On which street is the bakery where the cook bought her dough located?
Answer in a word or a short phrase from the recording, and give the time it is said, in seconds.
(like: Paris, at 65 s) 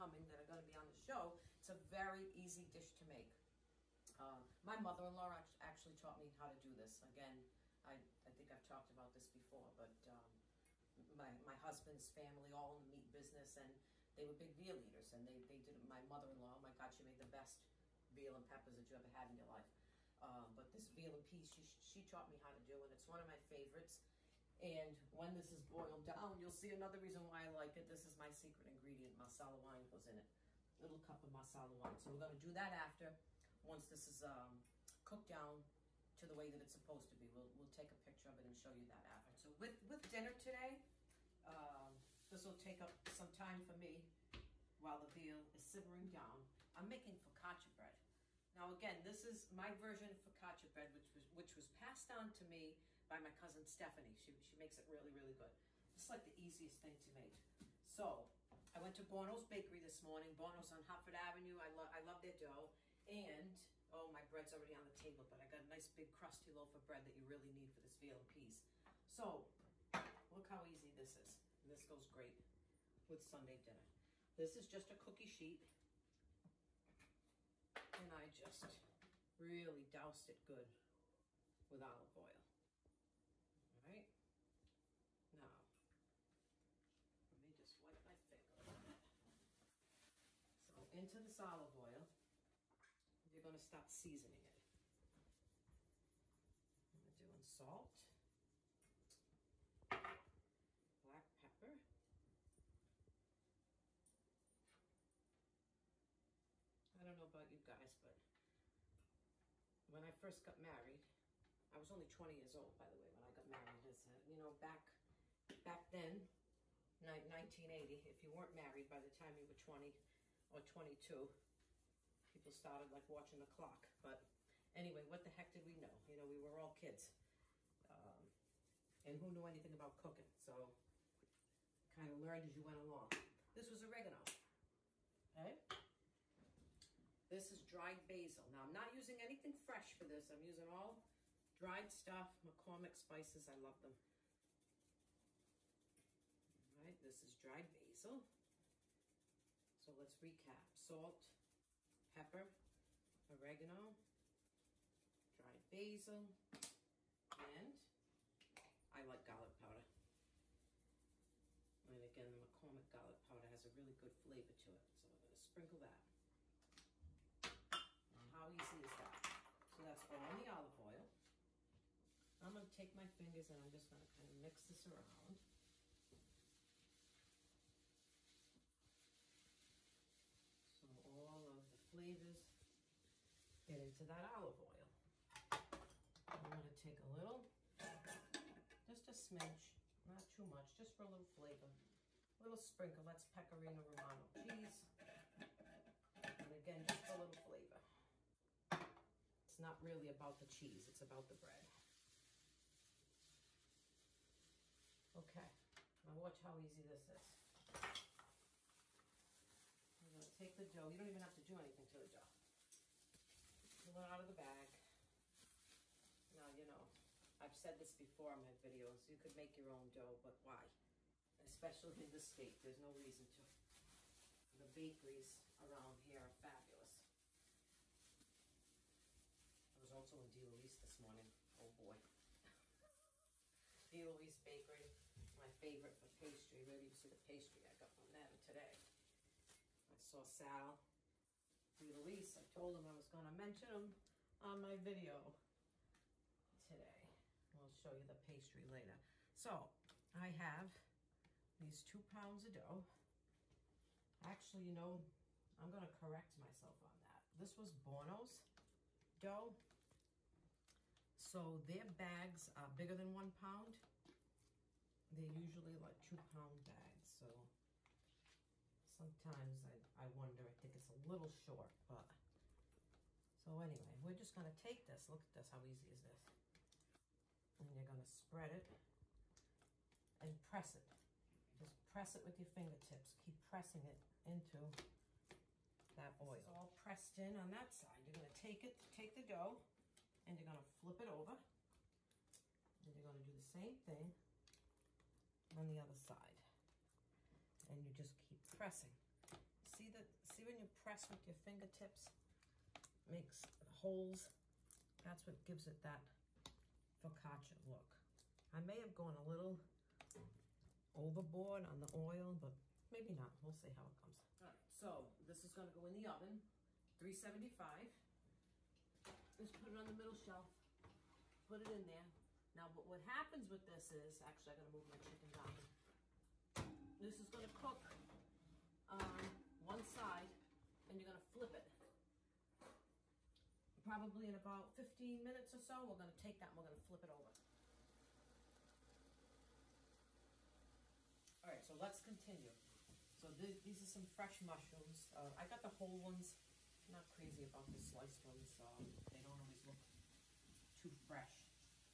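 Hartford Avenue, at 60 s.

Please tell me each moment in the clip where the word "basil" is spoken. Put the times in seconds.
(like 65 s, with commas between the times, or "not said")
138 s, 147 s, 155 s.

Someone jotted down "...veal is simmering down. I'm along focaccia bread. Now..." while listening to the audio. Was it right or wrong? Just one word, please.
wrong.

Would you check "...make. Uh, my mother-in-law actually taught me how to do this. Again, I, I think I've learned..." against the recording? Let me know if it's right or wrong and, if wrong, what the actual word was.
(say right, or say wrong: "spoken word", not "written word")
wrong: "talked", not "learned".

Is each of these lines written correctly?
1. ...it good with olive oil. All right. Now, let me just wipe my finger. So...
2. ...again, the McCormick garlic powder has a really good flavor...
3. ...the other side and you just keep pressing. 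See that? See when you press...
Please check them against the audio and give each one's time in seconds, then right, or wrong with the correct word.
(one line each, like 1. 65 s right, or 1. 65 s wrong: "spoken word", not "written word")
1. 80 s right
2. 162 s right
3. 295 s right.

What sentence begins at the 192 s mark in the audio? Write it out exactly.
A little sprinkle, that's pecorino romano cheese.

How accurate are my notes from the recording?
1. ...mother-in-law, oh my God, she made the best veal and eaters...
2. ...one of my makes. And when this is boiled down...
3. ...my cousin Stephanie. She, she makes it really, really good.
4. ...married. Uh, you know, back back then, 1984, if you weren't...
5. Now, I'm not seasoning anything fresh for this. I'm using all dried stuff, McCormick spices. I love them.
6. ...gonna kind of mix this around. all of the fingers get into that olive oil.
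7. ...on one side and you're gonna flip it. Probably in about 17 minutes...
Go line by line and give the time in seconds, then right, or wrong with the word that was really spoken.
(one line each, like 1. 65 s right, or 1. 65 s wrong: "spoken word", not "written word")
1. 16 s wrong: "peppers", not "eaters"
2. 23 s wrong: "favorites", not "makes"
3. 53 s right
4. 113 s wrong: "1980", not "1984"
5. 138 s wrong: "using", not "seasoning"
6. 173 s wrong: "flavors", not "fingers"
7. 328 s wrong: "15", not "17".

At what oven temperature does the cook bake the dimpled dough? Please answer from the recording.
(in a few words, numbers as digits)
375.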